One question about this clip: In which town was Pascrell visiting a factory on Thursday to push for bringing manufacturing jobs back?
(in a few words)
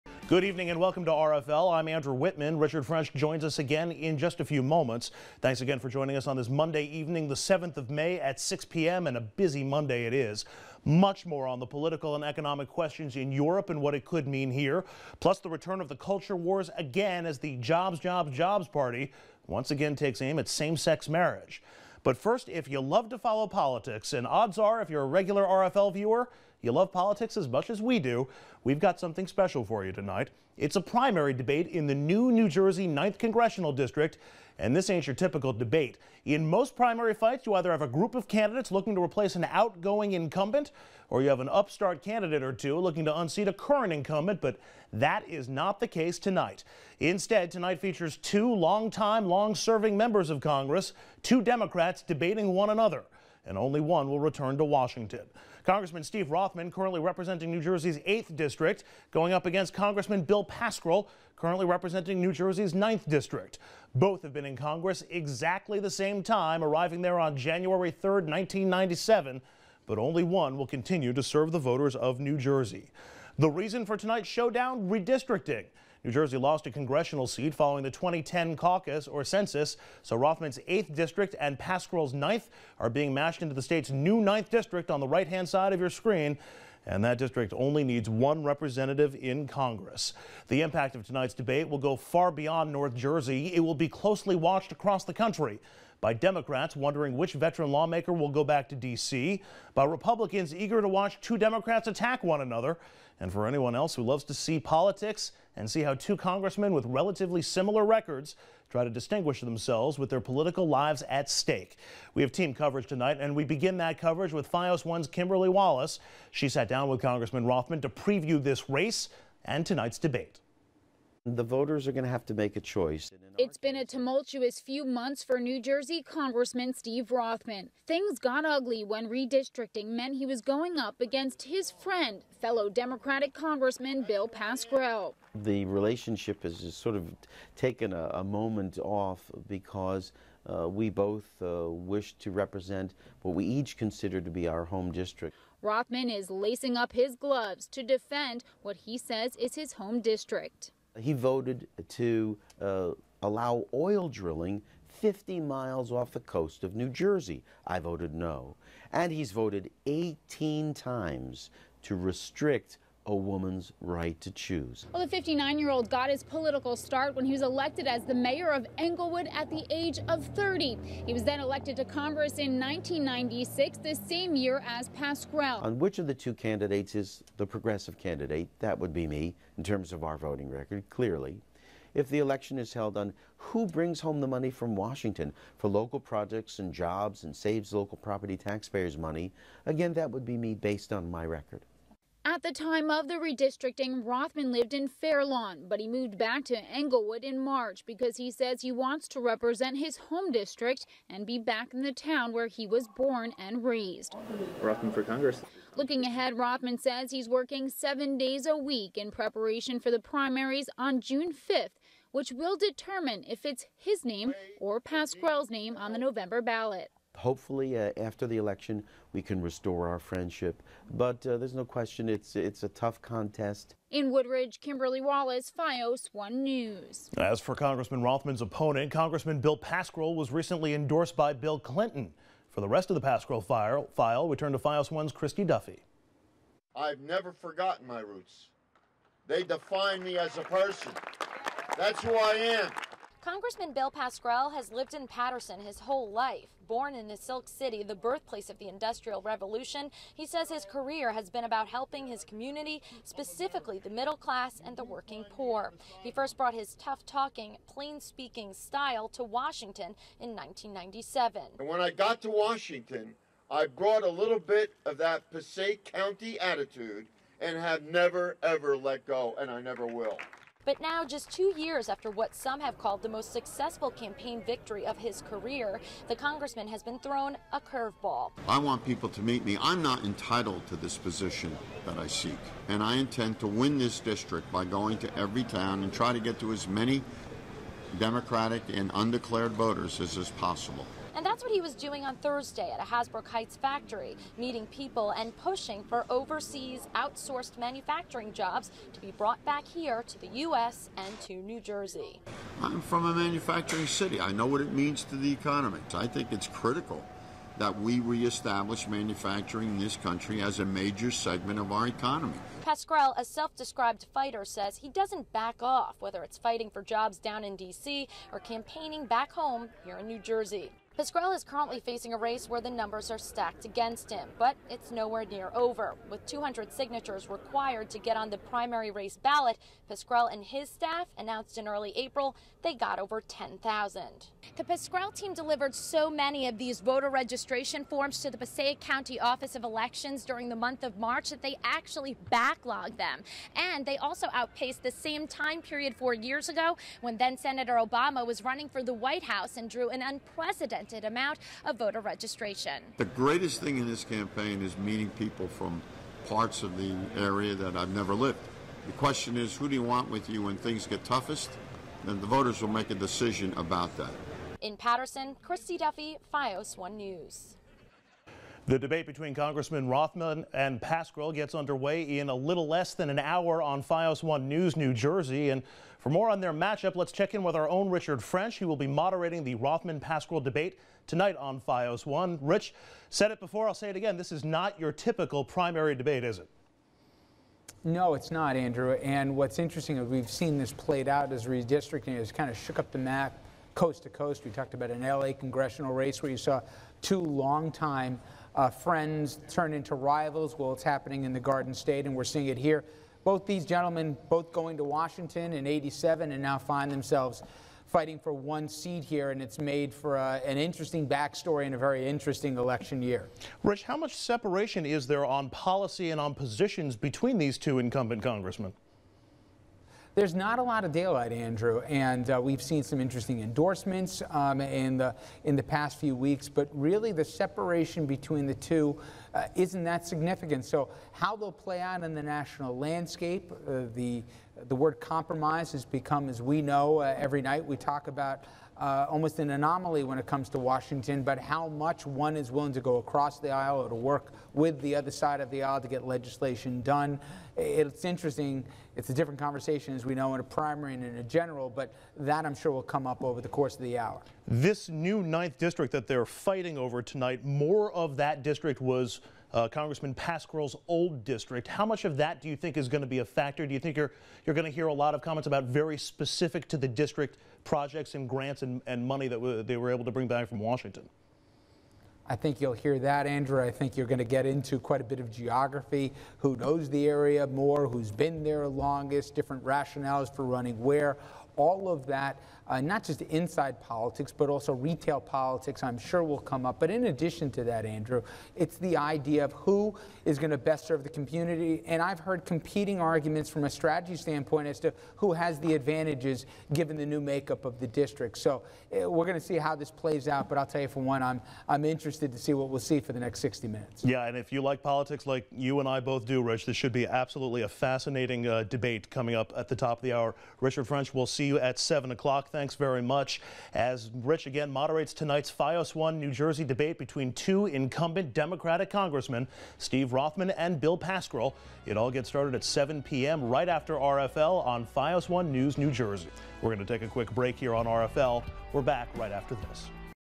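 Hasbrouck Heights.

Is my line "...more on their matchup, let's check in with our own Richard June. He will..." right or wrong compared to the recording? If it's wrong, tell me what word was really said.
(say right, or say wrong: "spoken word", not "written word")
wrong: "French", not "June".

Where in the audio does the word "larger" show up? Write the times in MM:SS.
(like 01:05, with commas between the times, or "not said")
not said.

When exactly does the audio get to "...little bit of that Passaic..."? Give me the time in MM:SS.
04:24.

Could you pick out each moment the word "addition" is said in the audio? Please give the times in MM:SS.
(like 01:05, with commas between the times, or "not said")
08:07.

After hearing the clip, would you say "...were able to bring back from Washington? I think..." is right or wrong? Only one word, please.
right.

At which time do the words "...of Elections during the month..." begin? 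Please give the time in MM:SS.
05:39.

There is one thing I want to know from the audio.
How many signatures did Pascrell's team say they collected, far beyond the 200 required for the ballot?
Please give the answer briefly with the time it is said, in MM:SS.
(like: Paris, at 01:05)
10,000, at 05:33.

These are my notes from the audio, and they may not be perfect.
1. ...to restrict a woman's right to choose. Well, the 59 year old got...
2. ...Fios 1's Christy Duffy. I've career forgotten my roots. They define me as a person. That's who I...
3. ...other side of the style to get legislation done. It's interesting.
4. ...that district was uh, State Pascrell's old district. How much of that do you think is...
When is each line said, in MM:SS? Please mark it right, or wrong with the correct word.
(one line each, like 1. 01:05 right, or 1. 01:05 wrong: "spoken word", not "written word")
1. 02:41 right
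2. 03:54 wrong: "never", not "career"
3. 07:24 wrong: "aisle", not "style"
4. 07:38 wrong: "Congressman", not "State".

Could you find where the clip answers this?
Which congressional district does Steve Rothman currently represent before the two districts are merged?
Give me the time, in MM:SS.
00:57.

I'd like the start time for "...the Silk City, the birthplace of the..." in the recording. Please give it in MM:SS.
04:07.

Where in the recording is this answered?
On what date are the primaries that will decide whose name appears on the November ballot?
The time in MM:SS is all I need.
03:31.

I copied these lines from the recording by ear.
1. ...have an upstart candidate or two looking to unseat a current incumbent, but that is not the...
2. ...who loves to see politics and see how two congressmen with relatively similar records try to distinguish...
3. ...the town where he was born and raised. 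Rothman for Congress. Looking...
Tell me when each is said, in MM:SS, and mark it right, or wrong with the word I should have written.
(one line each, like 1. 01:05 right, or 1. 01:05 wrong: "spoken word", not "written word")
1. 00:41 right
2. 01:43 right
3. 03:21 right.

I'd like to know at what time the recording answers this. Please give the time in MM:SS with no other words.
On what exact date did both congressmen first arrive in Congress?
01:07.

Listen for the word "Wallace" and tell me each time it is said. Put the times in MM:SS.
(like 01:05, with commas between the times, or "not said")
01:55, 03:45.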